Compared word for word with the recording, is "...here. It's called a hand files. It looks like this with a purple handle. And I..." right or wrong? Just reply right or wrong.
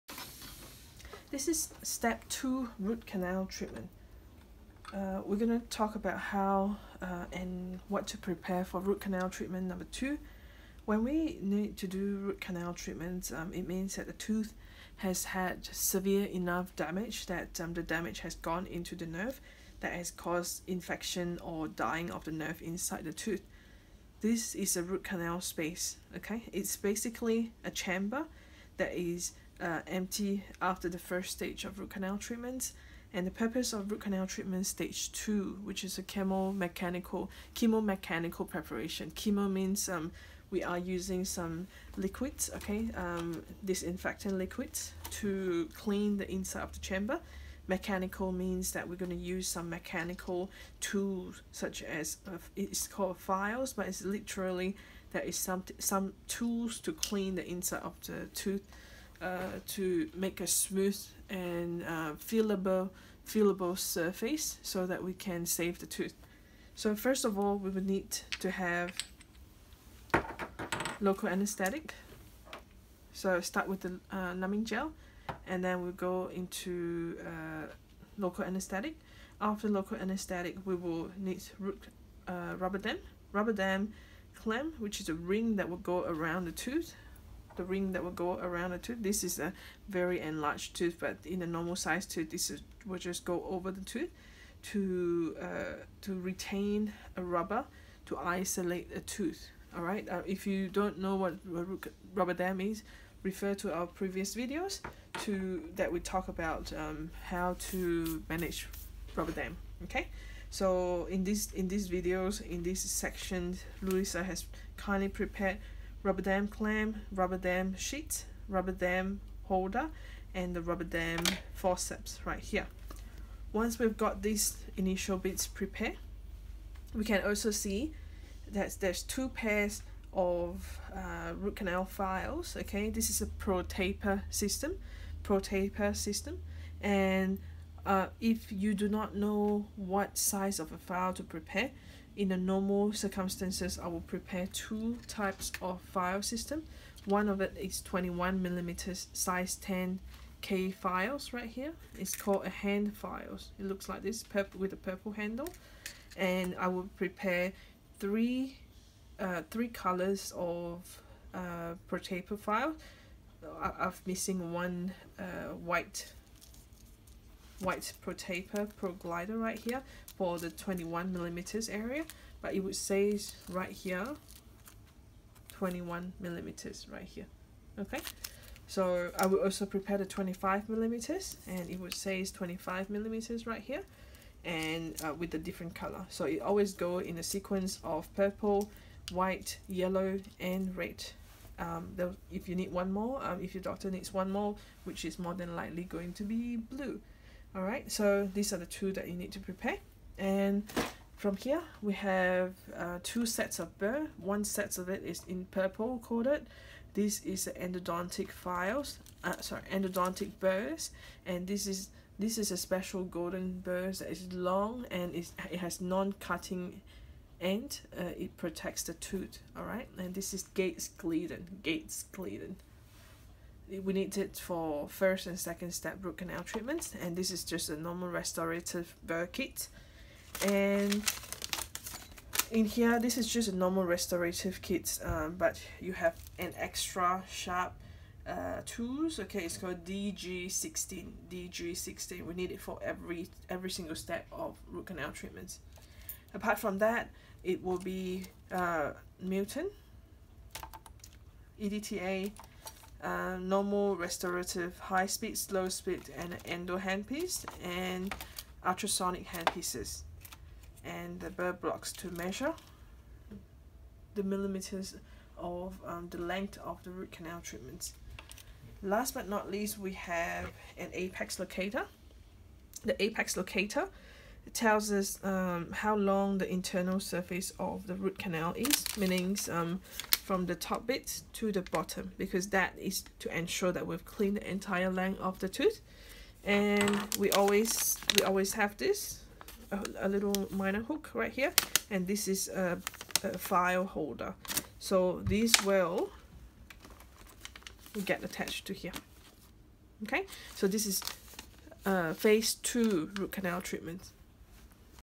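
right.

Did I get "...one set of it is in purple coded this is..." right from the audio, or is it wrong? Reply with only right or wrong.
right.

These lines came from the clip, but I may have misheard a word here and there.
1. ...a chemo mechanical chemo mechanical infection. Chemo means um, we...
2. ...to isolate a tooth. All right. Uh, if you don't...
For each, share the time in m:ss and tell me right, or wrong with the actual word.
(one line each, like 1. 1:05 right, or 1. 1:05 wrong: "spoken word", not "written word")
1. 0:35 wrong: "preparation", not "infection"
2. 1:38 right.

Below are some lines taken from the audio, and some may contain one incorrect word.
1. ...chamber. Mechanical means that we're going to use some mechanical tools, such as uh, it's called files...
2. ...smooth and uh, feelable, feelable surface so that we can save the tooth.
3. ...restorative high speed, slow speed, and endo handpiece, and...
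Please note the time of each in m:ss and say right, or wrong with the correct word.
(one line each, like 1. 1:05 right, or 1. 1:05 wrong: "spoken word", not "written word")
1. 0:46 right
2. 1:00 right
3. 4:13 right.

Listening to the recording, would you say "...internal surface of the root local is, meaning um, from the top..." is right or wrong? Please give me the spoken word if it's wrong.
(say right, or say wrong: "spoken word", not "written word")
wrong: "canal", not "local".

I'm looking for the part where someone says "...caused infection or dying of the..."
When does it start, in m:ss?
0:20.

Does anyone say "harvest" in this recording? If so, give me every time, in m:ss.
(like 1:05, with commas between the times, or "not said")
not said.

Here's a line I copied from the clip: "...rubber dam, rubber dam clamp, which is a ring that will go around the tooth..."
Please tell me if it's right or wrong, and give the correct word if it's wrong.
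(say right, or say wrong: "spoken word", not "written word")
right.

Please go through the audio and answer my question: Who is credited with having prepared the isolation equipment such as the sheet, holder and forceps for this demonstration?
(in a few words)
Louisa.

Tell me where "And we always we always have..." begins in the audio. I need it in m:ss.
4:46.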